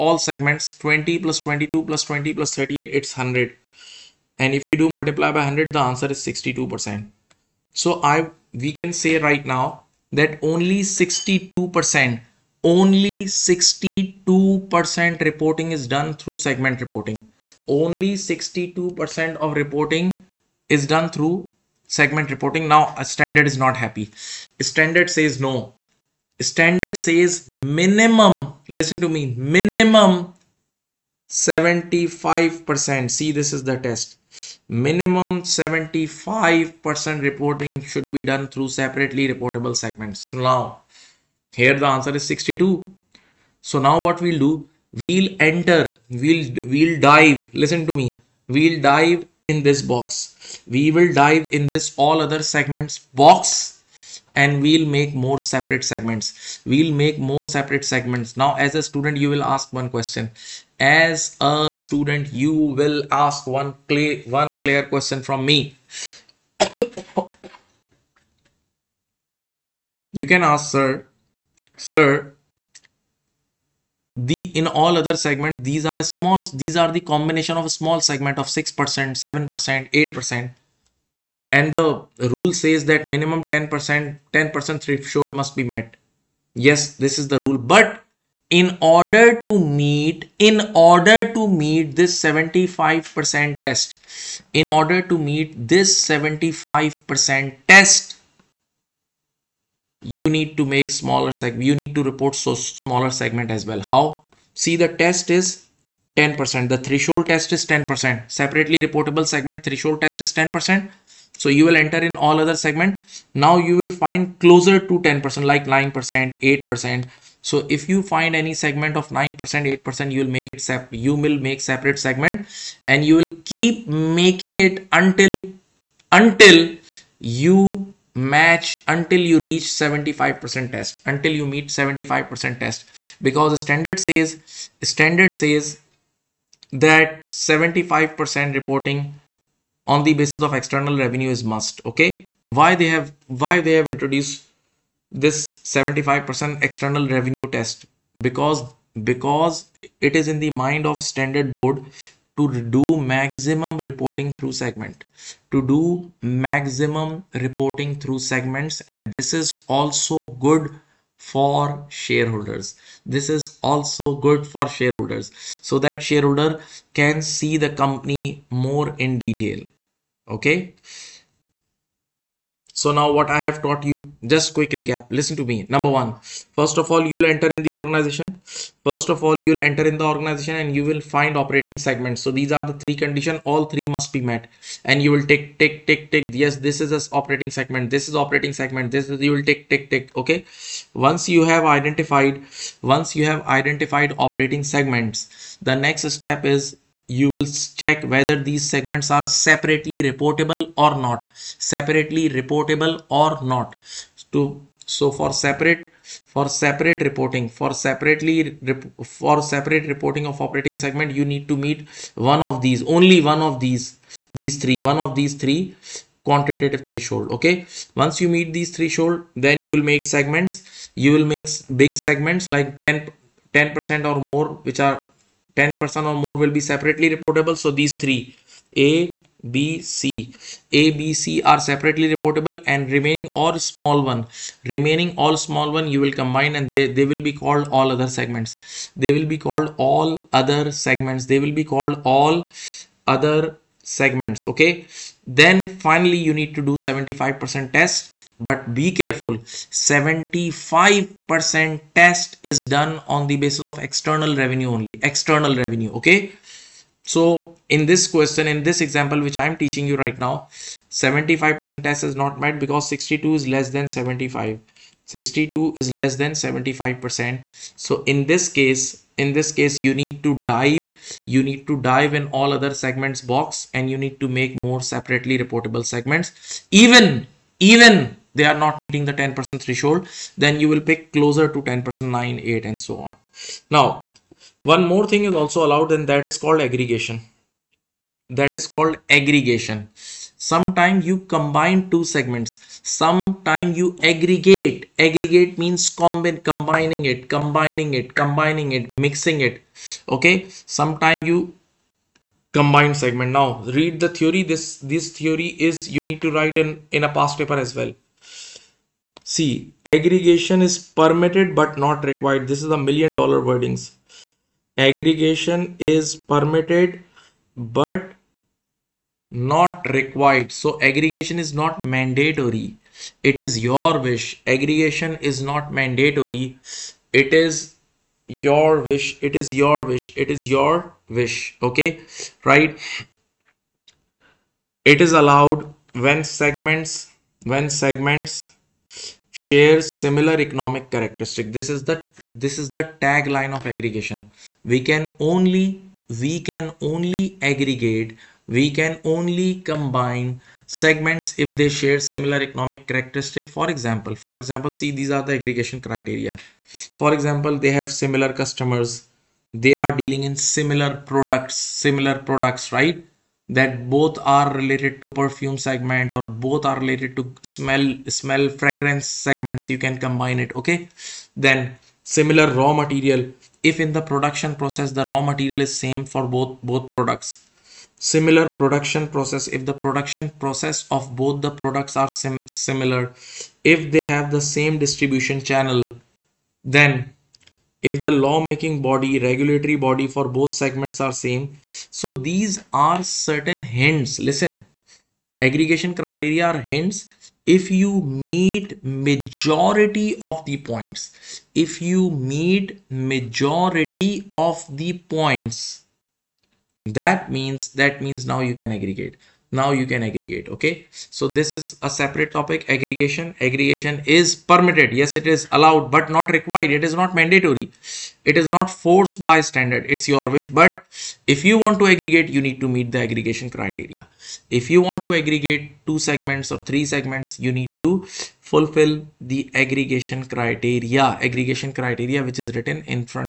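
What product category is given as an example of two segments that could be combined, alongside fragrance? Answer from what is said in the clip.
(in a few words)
Perfume.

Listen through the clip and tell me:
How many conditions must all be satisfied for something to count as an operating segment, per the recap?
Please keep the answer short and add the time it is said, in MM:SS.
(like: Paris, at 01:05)
3, at 03:02.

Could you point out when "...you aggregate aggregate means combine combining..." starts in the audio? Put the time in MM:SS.
04:53.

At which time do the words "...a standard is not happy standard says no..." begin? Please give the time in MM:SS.
00:22.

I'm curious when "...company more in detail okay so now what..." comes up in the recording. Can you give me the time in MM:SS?
02:47.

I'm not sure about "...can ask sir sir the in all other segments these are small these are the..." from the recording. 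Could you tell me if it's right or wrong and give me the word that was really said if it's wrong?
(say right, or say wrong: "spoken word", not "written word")
right.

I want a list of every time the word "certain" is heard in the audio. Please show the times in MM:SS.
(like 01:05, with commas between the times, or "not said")
06:33.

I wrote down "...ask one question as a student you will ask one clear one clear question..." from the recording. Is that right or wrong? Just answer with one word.
right.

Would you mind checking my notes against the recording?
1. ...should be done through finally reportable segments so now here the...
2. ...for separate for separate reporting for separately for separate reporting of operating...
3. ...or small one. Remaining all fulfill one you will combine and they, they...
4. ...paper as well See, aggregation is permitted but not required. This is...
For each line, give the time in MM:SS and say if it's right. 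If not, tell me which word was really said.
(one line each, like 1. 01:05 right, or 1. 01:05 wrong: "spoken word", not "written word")
1. 00:37 wrong: "separately", not "finally"
2. 03:25 right
3. 03:53 wrong: "small", not "fulfill"
4. 05:07 right.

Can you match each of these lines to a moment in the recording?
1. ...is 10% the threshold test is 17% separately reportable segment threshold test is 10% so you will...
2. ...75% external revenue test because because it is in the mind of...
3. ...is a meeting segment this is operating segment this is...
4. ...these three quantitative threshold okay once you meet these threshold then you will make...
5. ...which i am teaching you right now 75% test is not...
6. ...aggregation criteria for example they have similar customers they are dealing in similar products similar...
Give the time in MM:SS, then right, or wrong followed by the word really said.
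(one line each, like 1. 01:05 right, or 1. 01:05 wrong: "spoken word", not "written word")
1. 01:45 wrong: "10", not "17"
2. 02:25 right
3. 03:06 wrong: "operating", not "meeting"
4. 03:35 right
5. 04:19 right
6. 05:55 right.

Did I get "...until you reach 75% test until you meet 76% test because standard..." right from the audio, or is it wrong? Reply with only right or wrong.
wrong.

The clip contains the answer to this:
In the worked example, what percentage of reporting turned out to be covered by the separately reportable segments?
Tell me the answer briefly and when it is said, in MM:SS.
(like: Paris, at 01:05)
62%, at 00:05.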